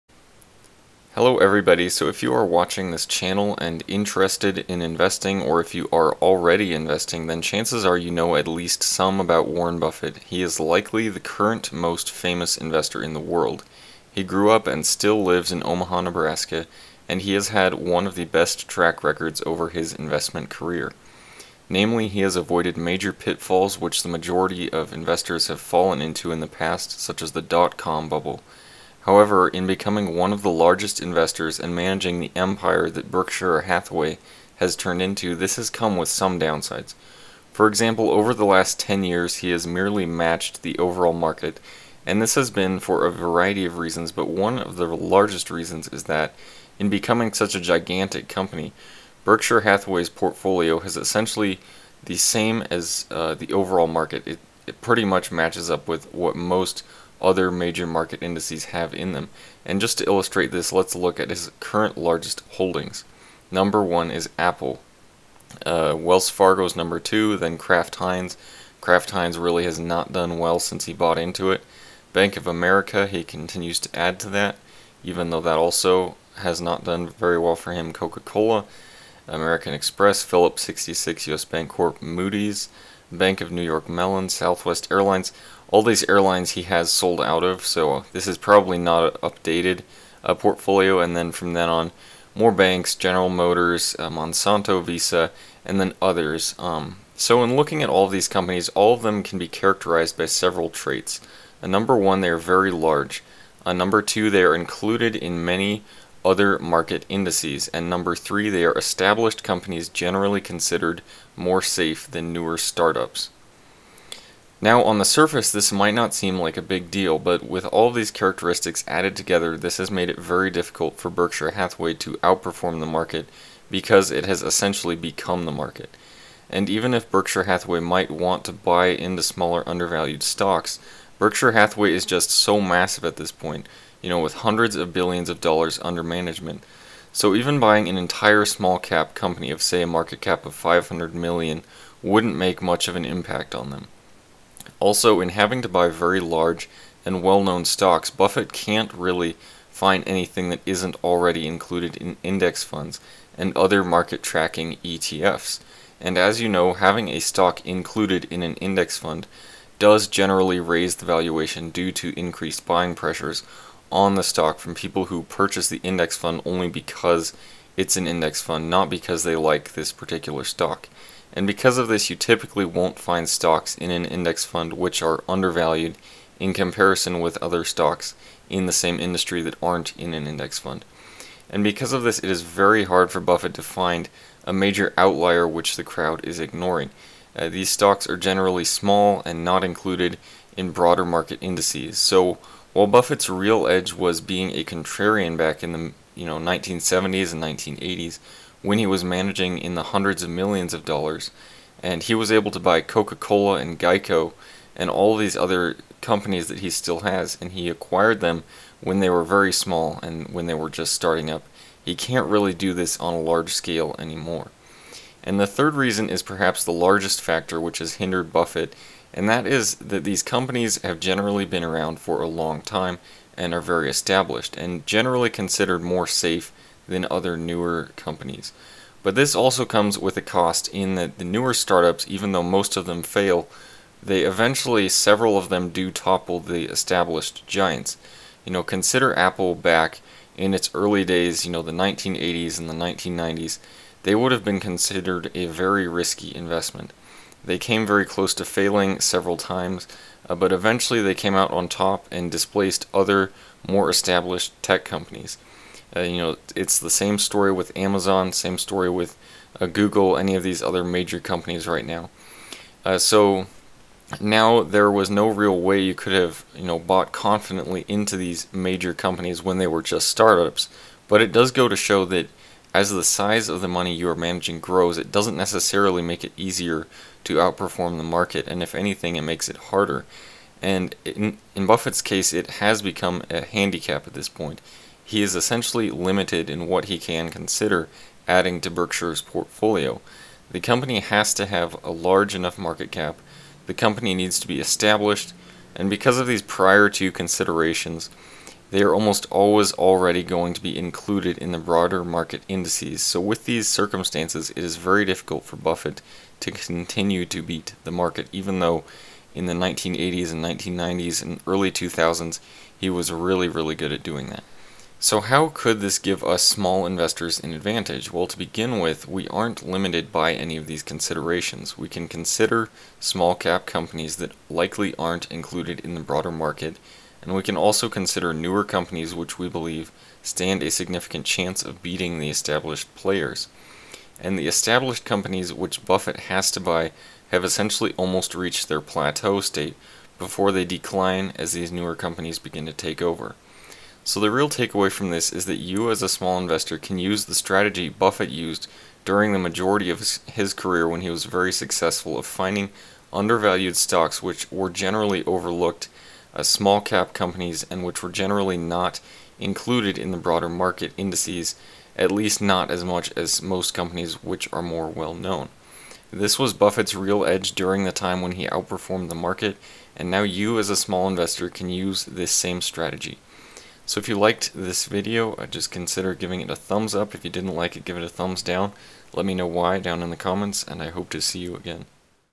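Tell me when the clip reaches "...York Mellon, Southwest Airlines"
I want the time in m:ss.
1:23.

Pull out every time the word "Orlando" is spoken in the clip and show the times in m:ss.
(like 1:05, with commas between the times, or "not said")
not said.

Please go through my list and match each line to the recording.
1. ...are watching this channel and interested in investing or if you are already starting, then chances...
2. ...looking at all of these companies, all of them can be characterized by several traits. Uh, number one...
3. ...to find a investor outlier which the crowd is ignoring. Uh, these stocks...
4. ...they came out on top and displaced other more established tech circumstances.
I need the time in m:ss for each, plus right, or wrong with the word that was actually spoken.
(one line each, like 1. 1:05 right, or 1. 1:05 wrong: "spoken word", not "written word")
1. 0:02 wrong: "investing", not "starting"
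2. 1:37 right
3. 3:03 wrong: "major", not "investor"
4. 4:11 wrong: "companies", not "circumstances".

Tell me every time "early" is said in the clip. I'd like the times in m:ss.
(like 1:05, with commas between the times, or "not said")
4:00, 5:11.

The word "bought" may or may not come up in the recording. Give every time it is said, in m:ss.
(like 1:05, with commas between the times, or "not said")
1:10, 4:26.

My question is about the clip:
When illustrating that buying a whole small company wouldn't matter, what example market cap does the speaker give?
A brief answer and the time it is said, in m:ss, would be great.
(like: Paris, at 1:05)
500 million, at 2:20.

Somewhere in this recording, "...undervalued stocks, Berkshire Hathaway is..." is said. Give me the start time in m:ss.
2:09.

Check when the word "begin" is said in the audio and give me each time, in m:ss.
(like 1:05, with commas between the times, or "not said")
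5:18, 5:42.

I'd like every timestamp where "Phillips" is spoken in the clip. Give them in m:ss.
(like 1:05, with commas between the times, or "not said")
1:20.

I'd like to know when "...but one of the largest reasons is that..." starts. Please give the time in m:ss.
0:44.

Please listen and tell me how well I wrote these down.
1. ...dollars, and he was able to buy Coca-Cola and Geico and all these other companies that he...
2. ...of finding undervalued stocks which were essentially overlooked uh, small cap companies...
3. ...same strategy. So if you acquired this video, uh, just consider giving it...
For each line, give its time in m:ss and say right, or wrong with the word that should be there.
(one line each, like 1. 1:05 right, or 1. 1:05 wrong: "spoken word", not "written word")
1. 3:20 right
2. 5:52 wrong: "generally", not "essentially"
3. 6:12 wrong: "liked", not "acquired".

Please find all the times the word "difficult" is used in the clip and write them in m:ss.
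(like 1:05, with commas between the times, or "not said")
2:00, 5:05.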